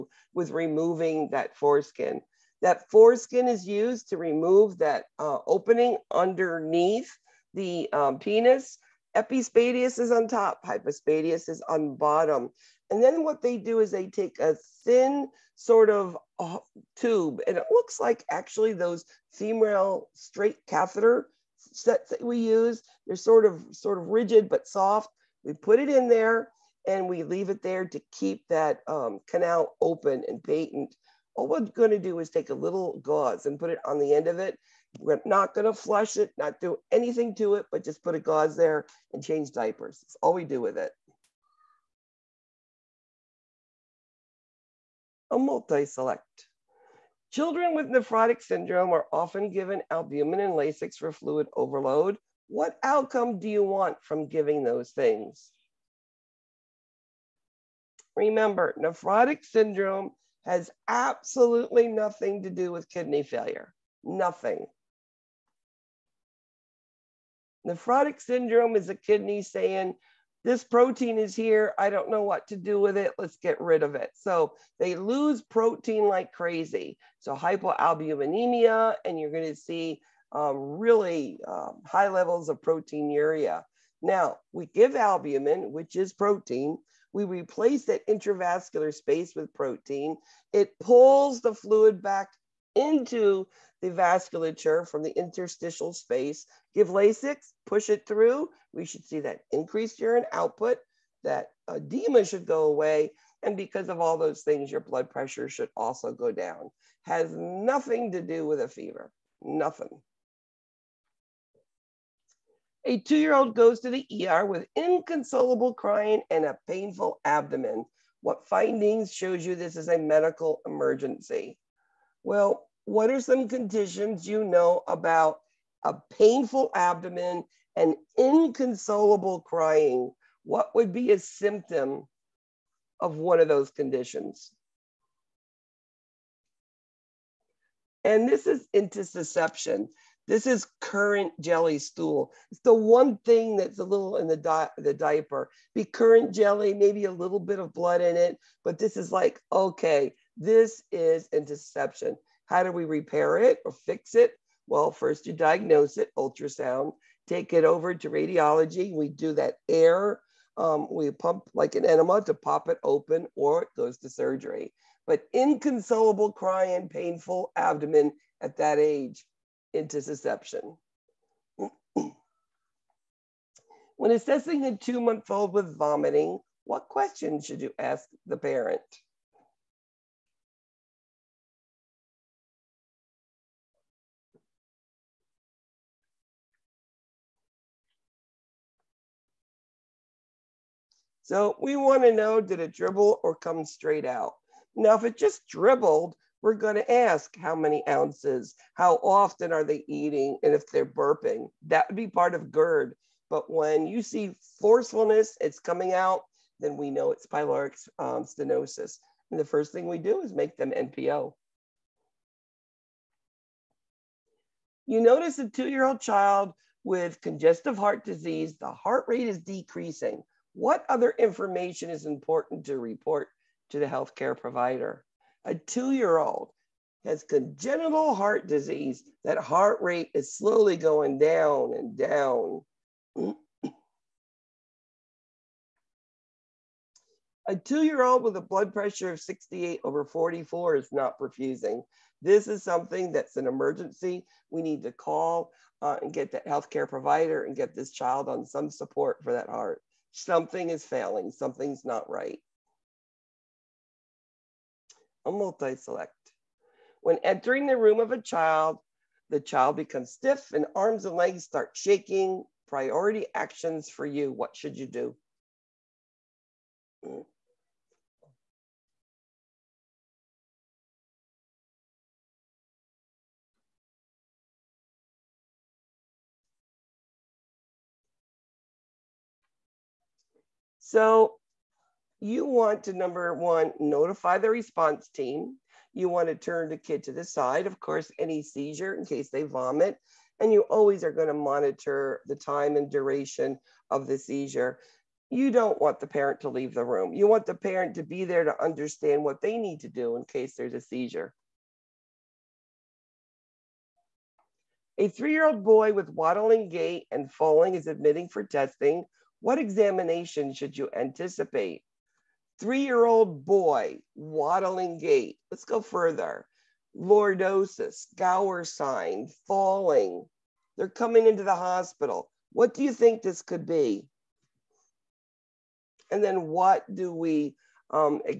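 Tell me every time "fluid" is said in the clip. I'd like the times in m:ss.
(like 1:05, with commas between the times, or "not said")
0:51, 1:31.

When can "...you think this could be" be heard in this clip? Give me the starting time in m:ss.
5:22.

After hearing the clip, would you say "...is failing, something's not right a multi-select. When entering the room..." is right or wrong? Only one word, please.
right.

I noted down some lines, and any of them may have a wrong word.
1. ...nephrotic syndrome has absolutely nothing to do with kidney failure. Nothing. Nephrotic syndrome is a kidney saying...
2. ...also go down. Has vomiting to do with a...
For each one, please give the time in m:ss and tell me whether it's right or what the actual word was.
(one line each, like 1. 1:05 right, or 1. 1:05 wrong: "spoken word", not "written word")
1. 0:58 right
2. 1:45 wrong: "nothing", not "vomiting".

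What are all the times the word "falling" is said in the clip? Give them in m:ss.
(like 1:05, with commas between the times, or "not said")
5:07, 5:19.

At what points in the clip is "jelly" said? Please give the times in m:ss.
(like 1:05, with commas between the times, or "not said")
2:21, 2:26.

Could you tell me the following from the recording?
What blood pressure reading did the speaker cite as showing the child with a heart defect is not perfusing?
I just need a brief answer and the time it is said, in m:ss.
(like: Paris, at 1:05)
68 over 44, at 3:59.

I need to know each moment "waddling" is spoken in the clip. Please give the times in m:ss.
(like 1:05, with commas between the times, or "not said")
5:06, 5:14.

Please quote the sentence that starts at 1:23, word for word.
Now, we give albumin, which is protein, we replace that intravascular space with protein.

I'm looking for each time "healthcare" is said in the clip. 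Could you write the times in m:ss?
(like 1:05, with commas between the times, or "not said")
3:43, 4:06.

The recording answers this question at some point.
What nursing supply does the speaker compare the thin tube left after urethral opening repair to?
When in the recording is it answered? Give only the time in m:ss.
0:19.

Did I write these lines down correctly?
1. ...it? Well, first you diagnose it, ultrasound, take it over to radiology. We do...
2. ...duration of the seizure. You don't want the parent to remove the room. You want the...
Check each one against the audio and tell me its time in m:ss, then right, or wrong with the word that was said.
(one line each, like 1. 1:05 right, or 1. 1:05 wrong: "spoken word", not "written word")
1. 2:34 right
2. 4:52 wrong: "leave", not "remove".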